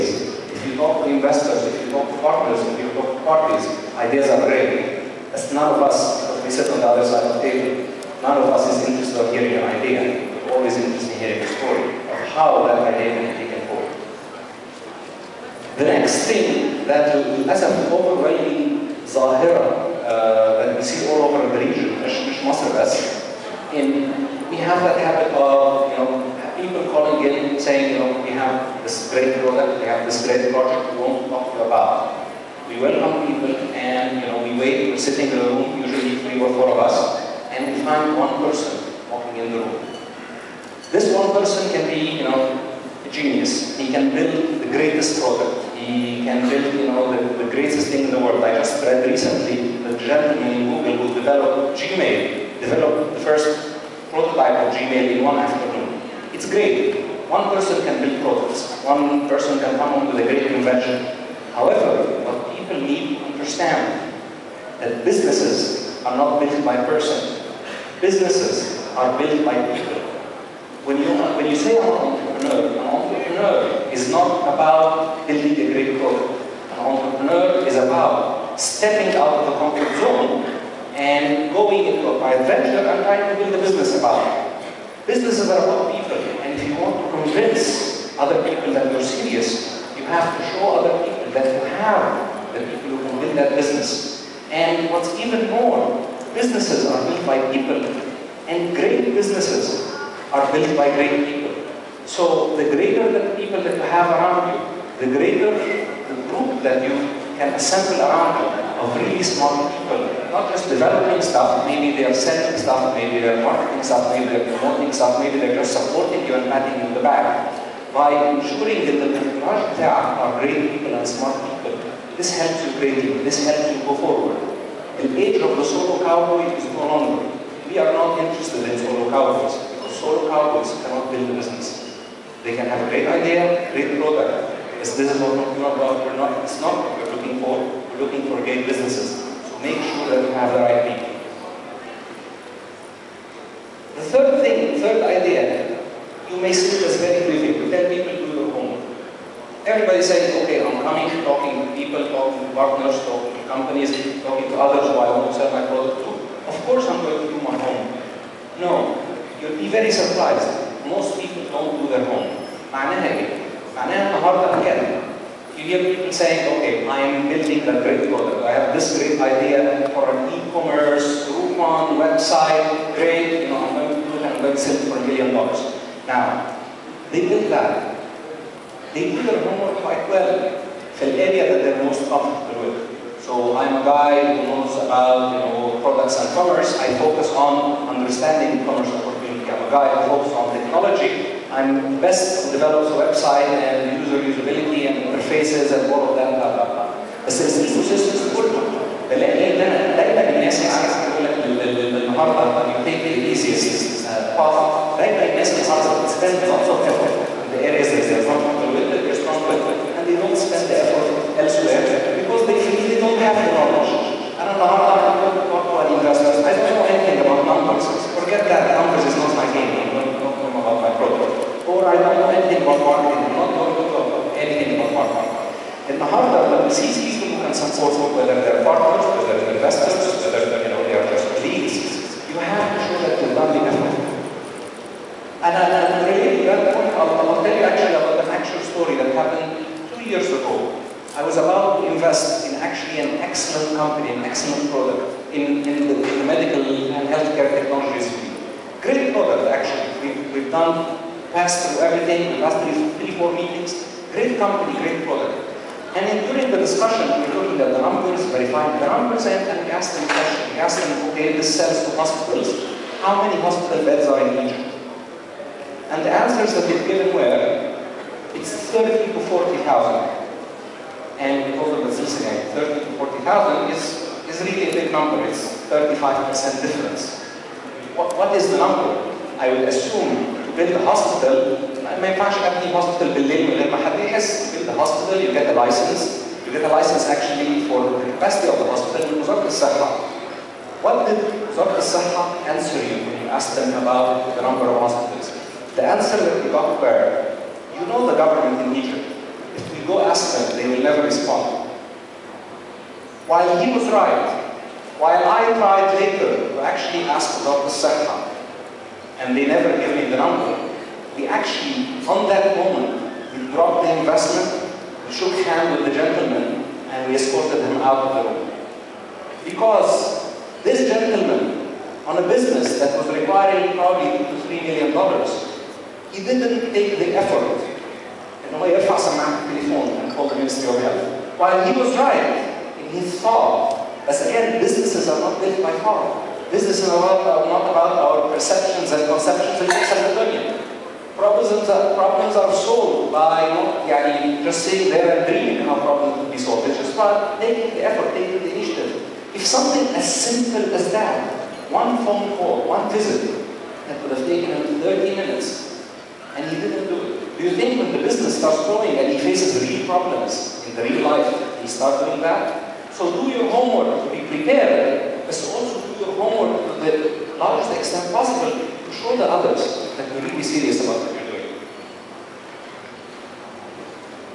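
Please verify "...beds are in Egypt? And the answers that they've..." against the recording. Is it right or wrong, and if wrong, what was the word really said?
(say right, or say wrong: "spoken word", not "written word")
right.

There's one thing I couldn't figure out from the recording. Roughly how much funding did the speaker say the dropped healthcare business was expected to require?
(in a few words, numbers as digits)
2 to 3 million dollars.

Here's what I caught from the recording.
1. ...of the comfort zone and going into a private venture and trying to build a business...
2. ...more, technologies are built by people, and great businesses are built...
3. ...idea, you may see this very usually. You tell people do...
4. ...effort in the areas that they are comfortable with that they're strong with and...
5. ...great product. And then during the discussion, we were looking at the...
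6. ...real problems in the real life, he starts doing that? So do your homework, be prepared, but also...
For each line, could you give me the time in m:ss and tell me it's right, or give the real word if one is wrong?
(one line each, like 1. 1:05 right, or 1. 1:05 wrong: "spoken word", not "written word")
1. 1:19 right
2. 1:35 wrong: "businesses", not "technologies"
3. 2:25 wrong: "briefly", not "usually"
4. 3:26 right
5. 4:14 right
6. 5:59 right.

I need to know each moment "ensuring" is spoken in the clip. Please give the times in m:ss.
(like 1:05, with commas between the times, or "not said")
1:58.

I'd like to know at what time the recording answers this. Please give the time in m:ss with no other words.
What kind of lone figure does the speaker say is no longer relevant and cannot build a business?
2:05.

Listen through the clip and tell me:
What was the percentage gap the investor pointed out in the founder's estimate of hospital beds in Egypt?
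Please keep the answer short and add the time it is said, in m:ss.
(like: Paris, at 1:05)
35%, at 4:35.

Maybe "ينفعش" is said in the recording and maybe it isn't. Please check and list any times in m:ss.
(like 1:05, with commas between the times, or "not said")
4:42.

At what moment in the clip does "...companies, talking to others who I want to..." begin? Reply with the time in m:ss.
2:33.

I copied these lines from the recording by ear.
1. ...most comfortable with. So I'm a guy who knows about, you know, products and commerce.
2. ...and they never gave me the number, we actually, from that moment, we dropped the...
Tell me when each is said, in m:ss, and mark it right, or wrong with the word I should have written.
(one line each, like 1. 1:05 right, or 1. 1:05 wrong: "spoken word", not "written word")
1. 3:01 right
2. 5:09 right.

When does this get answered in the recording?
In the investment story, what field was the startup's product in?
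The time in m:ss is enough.
4:06.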